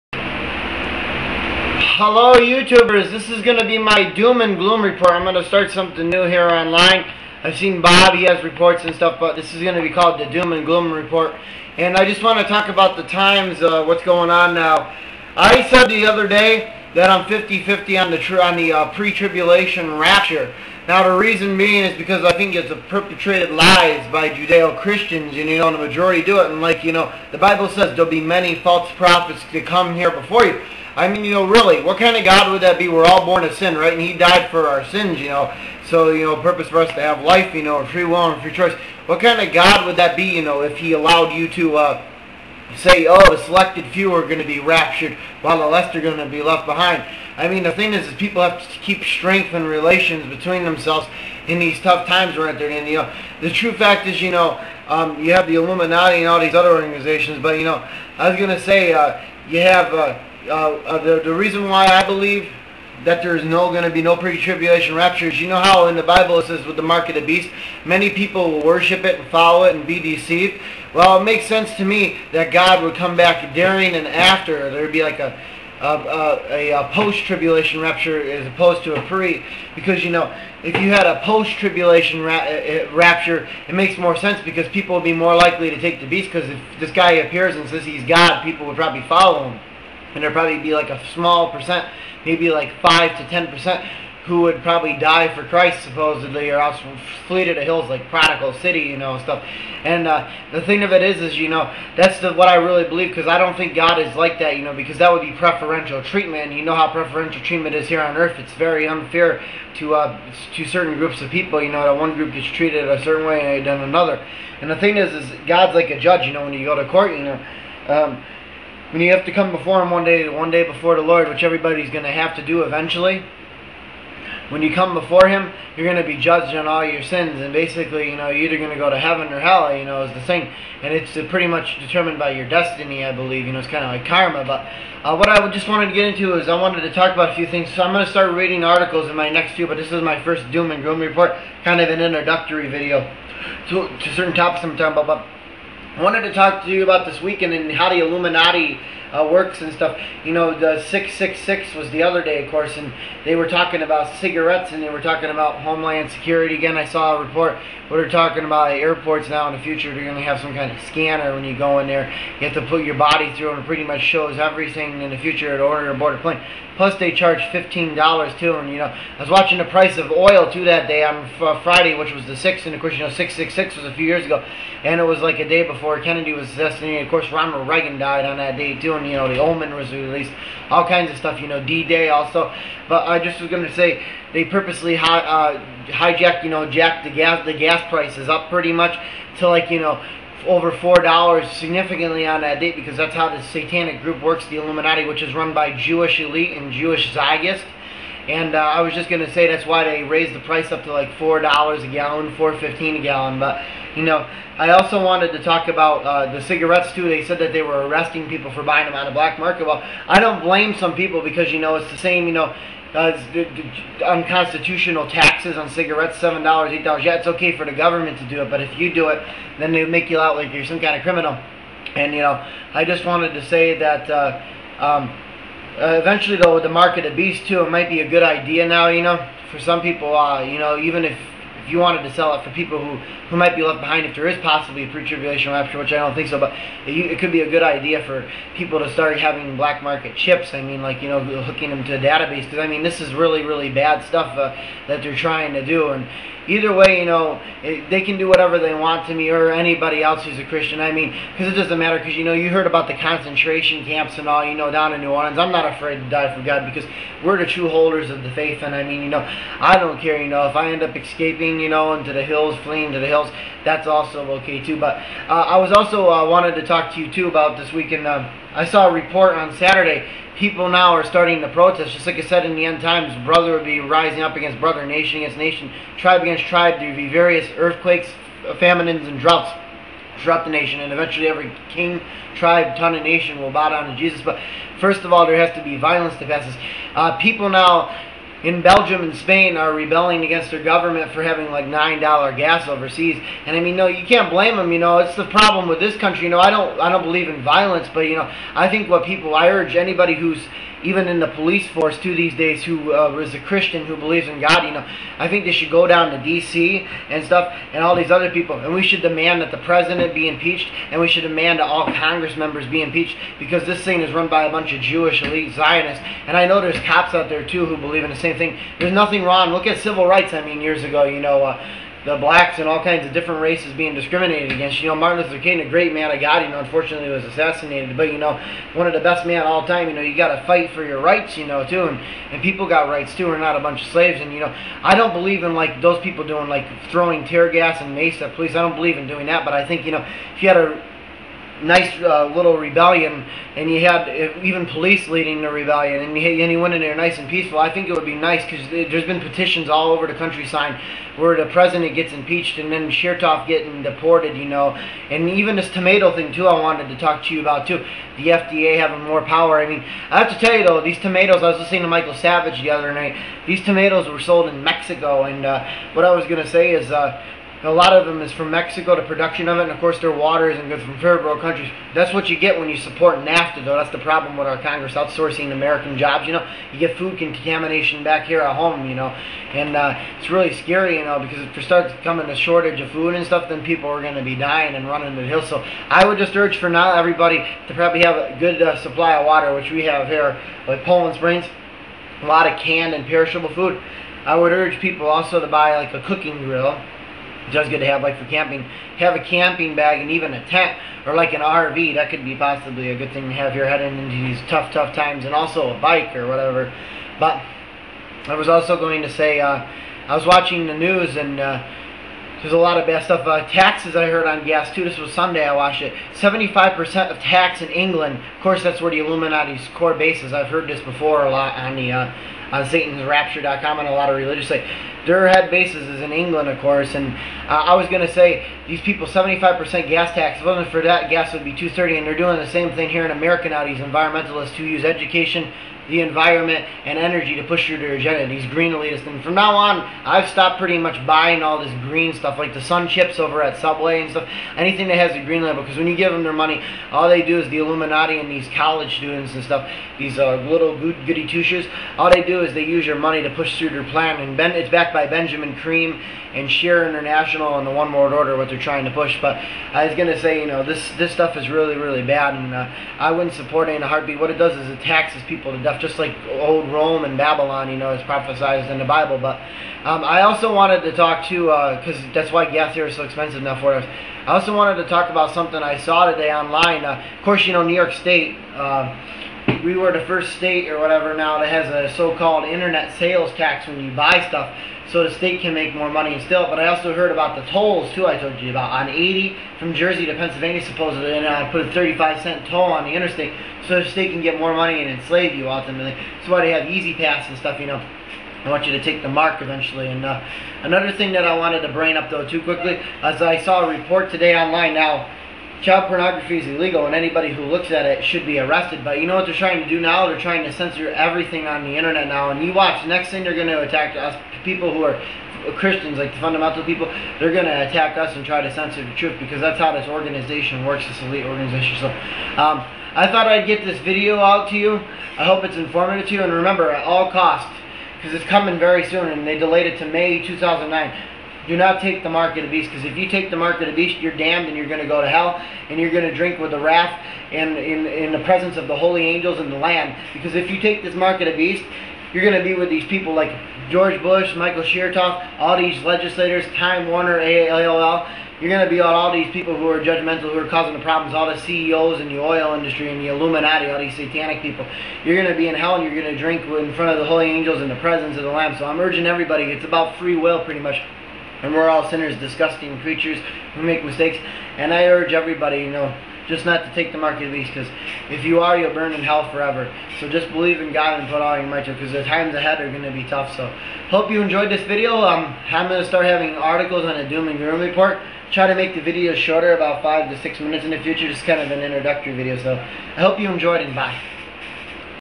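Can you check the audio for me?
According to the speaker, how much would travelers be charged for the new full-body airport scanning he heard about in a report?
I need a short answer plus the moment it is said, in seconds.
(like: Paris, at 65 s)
$15, at 167 s.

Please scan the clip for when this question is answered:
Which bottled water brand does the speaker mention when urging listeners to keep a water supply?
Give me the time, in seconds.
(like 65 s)
390 s.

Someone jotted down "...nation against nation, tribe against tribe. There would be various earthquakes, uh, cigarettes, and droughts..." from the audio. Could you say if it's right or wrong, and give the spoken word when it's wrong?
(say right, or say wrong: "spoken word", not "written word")
wrong: "famines", not "cigarettes".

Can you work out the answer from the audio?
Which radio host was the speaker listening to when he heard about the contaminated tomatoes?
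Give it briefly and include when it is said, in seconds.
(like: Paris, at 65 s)
Michael Savage, at 361 s.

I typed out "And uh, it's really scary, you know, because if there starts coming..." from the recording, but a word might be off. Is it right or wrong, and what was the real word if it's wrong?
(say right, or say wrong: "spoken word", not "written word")
right.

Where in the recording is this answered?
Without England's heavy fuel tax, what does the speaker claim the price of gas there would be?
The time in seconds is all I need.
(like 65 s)
431 s.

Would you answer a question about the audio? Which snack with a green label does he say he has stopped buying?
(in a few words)
Sun Chips.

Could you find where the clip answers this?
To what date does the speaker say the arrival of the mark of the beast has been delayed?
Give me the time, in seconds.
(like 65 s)
529 s.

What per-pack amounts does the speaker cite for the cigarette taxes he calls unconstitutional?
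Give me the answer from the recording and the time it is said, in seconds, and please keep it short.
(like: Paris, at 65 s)
$7, $8, at 216 s.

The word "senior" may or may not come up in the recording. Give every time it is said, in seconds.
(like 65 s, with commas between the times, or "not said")
not said.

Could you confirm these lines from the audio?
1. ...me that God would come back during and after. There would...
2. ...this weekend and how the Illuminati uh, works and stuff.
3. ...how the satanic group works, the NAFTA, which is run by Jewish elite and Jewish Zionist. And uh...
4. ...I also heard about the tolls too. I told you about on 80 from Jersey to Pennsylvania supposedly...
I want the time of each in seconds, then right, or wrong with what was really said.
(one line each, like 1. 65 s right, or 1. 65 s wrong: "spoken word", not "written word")
1. 71 s right
2. 147 s right
3. 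193 s wrong: "Illuminati", not "NAFTA"
4. 486 s right.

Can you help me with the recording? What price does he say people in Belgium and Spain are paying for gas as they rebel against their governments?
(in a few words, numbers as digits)
$9.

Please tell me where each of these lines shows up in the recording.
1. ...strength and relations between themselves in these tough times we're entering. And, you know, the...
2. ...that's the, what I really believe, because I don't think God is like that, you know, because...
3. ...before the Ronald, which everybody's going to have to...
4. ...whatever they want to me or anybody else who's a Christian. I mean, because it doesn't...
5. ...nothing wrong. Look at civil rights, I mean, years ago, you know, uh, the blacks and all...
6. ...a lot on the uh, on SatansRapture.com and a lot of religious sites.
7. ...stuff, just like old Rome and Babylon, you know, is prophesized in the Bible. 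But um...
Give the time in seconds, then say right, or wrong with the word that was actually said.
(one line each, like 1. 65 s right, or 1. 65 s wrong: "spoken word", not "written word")
1. 49 s right
2. 101 s right
3. 120 s wrong: "Lord", not "Ronald"
4. 248 s right
5. 318 s right
6. 421 s right
7. 465 s right.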